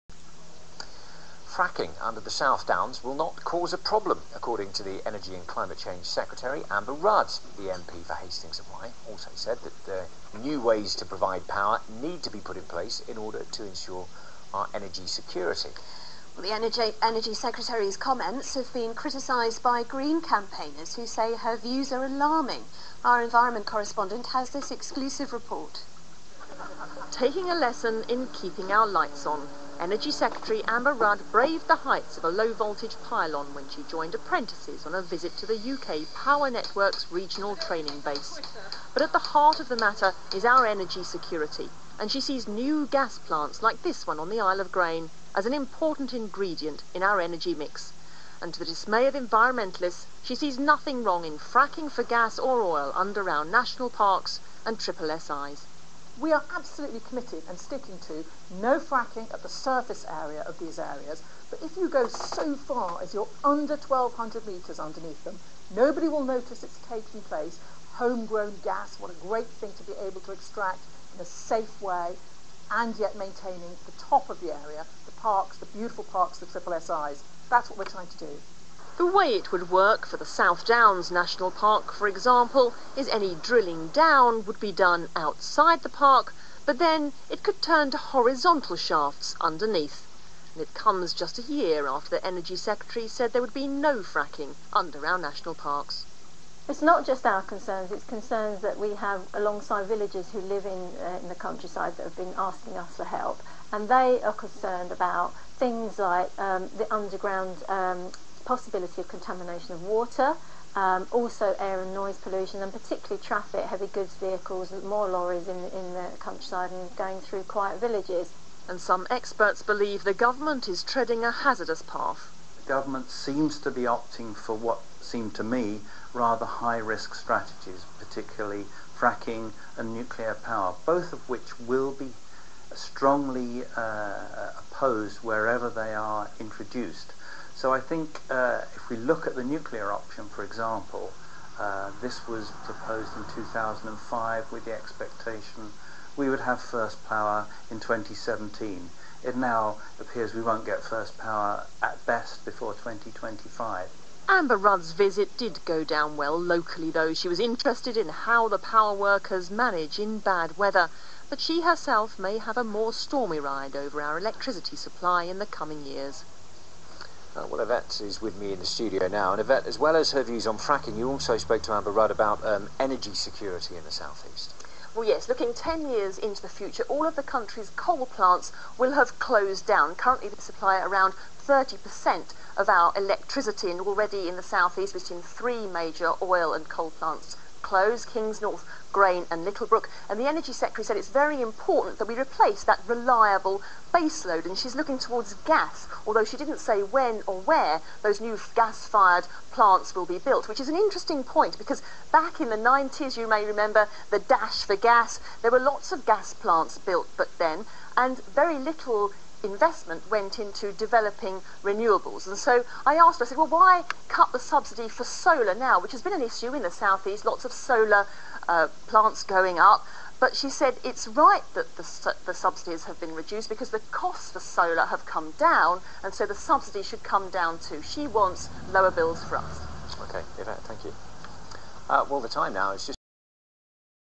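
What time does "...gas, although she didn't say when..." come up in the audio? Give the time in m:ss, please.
3:15.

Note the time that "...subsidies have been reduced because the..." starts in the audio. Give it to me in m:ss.
3:42.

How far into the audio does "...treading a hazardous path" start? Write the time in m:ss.
2:00.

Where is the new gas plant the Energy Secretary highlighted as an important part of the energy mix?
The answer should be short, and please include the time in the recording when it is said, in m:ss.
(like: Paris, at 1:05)
Isle of Grain, at 0:44.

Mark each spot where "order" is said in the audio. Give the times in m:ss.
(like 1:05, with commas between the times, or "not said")
0:13.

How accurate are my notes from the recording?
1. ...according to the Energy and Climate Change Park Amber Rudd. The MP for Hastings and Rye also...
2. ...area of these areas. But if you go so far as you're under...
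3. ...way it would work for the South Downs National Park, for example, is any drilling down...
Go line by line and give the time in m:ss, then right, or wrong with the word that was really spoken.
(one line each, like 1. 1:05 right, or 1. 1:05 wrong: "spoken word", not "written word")
1. 0:04 wrong: "Secretary", not "Park"
2. 1:00 right
3. 1:19 right.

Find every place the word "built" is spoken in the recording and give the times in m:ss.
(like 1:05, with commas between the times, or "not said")
3:20, 3:26.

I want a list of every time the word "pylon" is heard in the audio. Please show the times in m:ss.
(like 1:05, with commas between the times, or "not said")
0:33.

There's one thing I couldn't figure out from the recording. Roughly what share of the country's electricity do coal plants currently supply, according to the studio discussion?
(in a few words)
30%.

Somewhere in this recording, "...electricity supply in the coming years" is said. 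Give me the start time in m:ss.
2:44.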